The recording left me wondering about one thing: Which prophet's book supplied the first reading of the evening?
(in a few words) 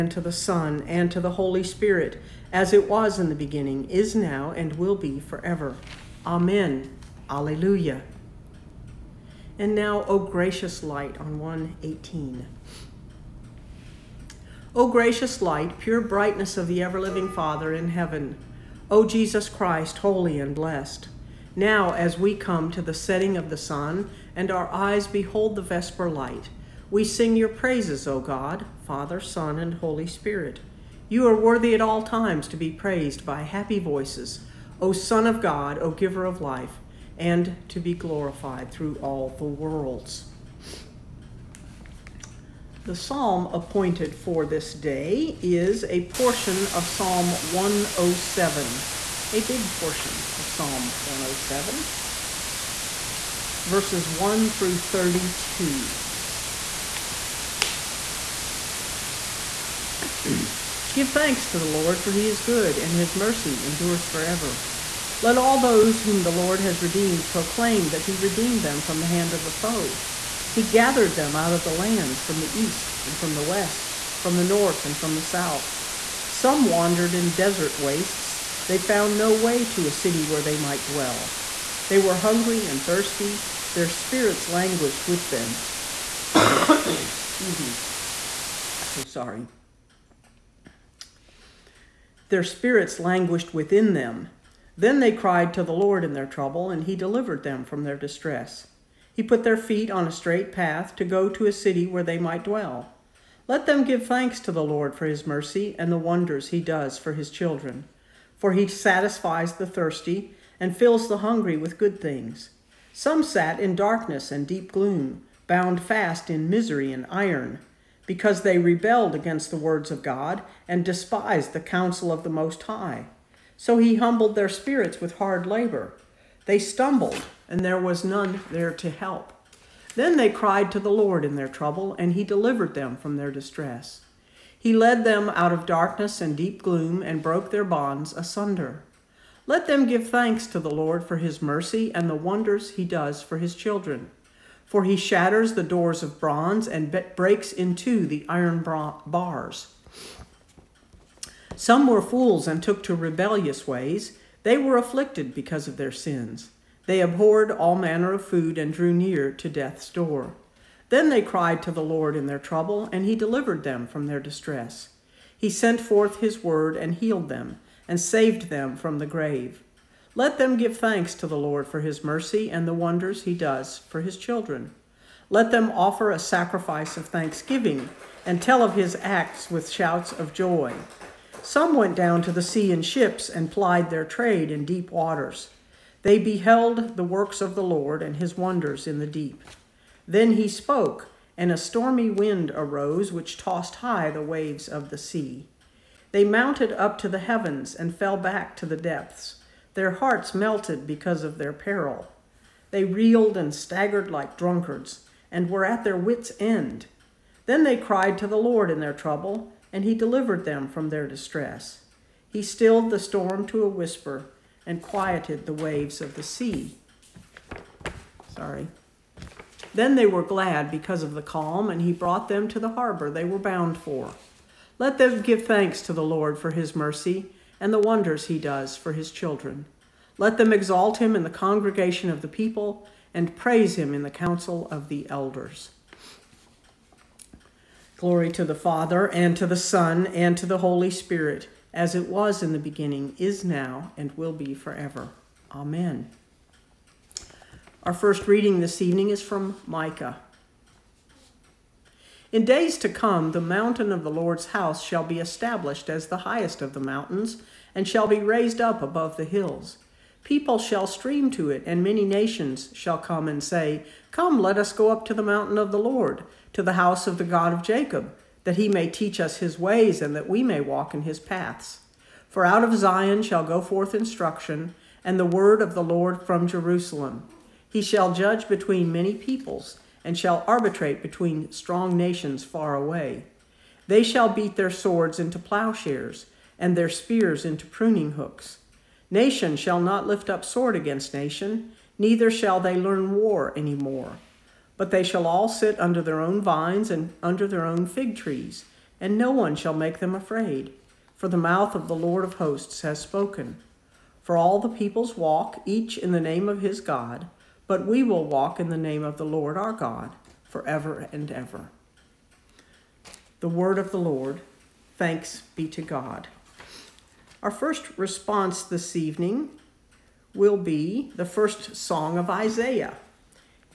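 Micah.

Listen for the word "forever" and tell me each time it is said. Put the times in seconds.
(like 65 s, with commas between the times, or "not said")
5 s, 64 s, 244 s, 310 s.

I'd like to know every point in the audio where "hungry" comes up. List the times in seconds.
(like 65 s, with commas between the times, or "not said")
82 s, 111 s.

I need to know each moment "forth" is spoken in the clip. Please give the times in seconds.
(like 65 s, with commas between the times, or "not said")
165 s, 273 s.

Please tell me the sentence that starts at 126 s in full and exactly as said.
They stumbled, and there was none there to help.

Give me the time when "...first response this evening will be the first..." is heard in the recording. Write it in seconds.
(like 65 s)
317 s.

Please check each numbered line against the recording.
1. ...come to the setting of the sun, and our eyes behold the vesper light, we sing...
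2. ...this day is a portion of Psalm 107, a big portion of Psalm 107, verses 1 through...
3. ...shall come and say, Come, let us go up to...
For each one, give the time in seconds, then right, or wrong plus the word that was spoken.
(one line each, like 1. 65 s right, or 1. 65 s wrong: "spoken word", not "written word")
1. 22 s right
2. 44 s right
3. 262 s right.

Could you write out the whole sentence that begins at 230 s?
Let them exalt him in the congregation of the people and praise him in the council of the elders.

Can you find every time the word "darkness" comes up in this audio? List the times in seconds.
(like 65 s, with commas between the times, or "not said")
113 s, 135 s.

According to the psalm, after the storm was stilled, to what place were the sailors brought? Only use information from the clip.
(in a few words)
the harbor.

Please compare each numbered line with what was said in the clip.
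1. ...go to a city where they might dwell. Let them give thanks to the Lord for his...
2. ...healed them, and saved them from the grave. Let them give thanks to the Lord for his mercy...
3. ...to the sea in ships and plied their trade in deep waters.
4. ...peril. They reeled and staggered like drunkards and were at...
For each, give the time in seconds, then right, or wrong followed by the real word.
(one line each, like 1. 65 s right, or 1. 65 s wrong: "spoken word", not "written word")
1. 101 s right
2. 166 s right
3. 182 s right
4. 201 s right.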